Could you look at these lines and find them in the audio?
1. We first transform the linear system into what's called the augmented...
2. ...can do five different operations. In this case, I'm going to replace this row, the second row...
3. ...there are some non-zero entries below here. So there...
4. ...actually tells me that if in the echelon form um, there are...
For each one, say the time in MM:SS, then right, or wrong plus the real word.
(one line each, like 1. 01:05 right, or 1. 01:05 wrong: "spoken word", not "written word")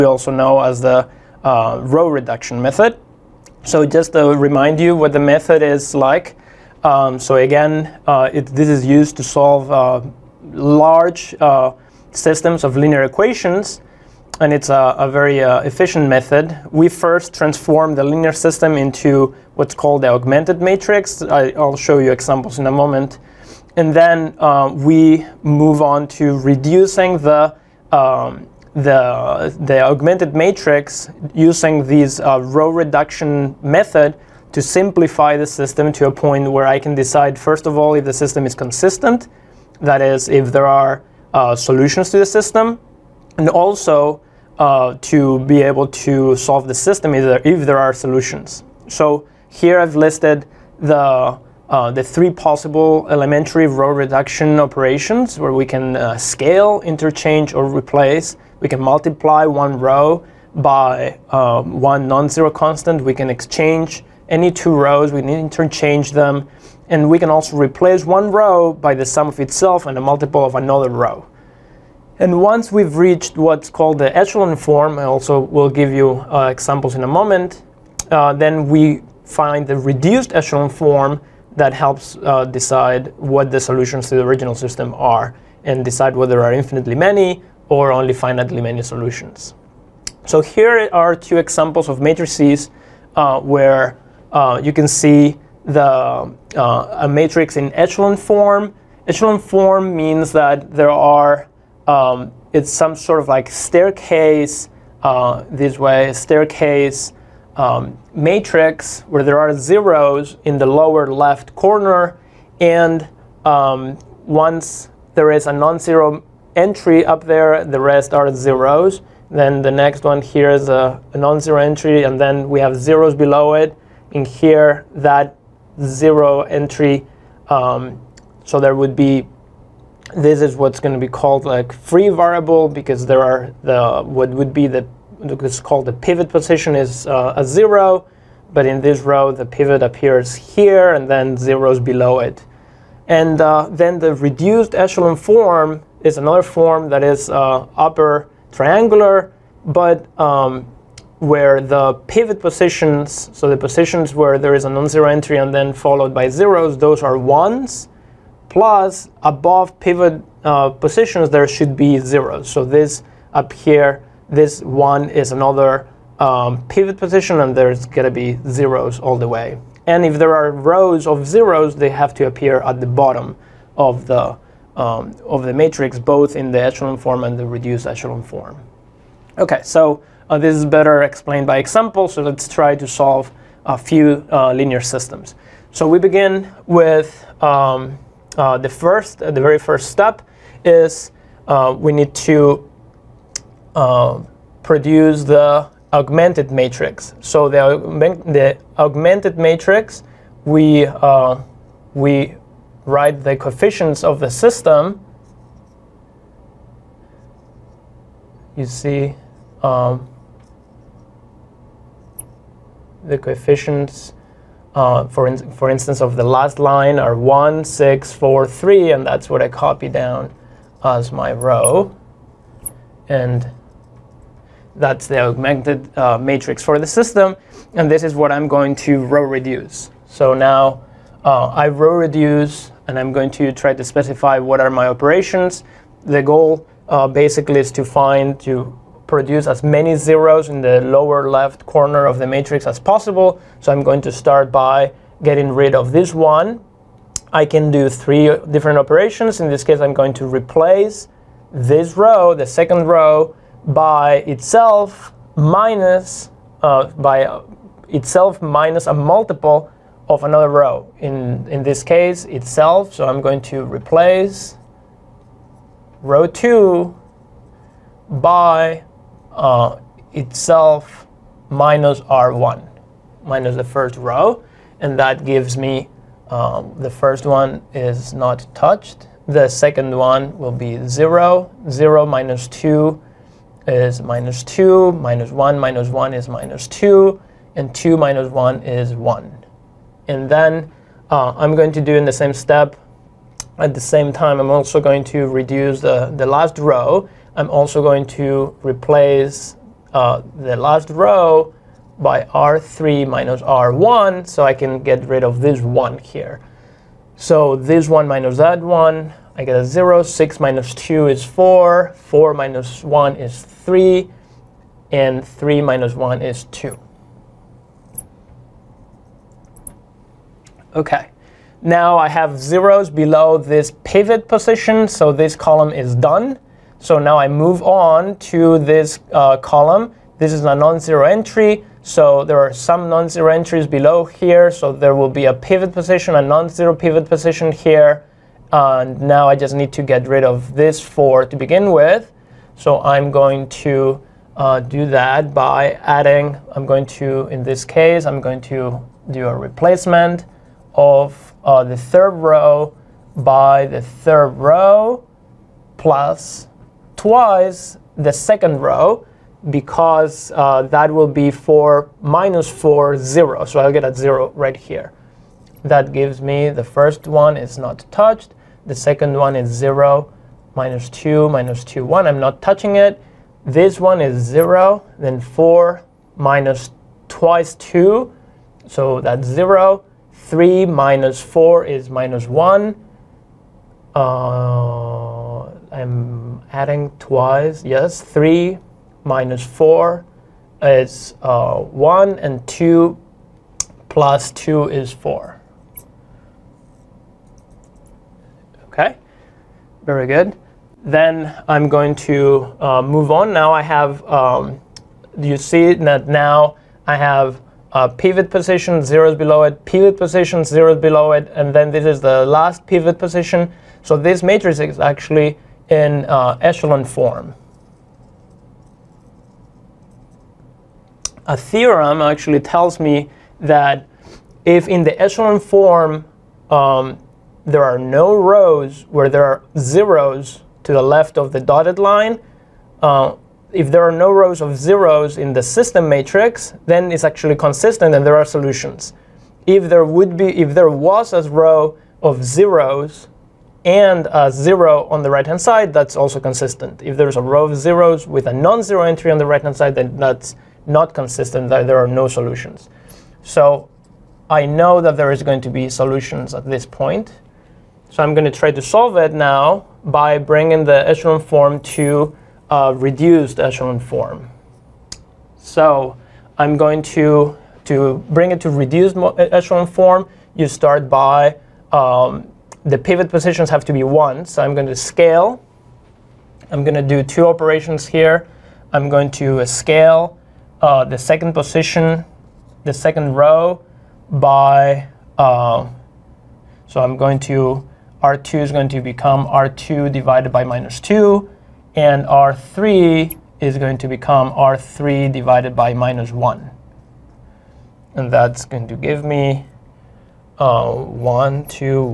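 1. 00:16 right
2. 04:07 wrong: "three", not "five"
3. 05:32 right
4. 07:02 right.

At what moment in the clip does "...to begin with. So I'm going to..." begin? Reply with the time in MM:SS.
05:41.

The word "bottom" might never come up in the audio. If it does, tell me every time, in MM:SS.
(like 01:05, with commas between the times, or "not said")
02:52.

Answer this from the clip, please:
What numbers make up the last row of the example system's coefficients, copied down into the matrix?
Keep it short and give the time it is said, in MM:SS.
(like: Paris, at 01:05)
1, 6, 4, 3, at 03:37.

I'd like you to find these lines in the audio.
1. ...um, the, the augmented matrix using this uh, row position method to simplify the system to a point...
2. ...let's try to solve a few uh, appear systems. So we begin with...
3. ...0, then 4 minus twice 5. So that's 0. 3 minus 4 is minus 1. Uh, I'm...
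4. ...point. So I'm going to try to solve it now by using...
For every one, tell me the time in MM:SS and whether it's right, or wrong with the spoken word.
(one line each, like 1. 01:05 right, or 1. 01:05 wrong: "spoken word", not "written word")
1. 00:27 wrong: "reduction", not "position"
2. 03:02 wrong: "linear", not "appear"
3. 06:14 wrong: "2", not "5"
4. 07:36 wrong: "bringing", not "using".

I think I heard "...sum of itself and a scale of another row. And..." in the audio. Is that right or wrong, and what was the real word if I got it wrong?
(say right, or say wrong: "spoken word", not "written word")
wrong: "multiple", not "scale".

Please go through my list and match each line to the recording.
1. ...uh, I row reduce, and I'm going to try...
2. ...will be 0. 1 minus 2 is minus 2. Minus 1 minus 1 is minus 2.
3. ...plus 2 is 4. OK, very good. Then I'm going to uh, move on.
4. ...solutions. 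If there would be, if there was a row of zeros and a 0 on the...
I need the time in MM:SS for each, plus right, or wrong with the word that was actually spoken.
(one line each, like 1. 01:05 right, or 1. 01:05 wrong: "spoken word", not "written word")
1. 03:51 right
2. 04:40 wrong: "0", not "1"
3. 06:33 right
4. 07:18 right.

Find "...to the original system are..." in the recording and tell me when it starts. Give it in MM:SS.
01:24.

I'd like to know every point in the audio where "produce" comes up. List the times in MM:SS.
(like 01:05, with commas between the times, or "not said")
03:14, 03:59.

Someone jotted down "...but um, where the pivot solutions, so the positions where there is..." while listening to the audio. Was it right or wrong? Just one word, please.
wrong.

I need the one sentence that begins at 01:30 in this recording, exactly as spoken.
So here are two examples of matrices uh, where uh, you can see the, uh, a matrix in echelon form.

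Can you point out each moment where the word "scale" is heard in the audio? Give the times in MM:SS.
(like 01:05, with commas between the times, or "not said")
00:56, 07:54, 07:59.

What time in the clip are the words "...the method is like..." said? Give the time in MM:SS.
00:05.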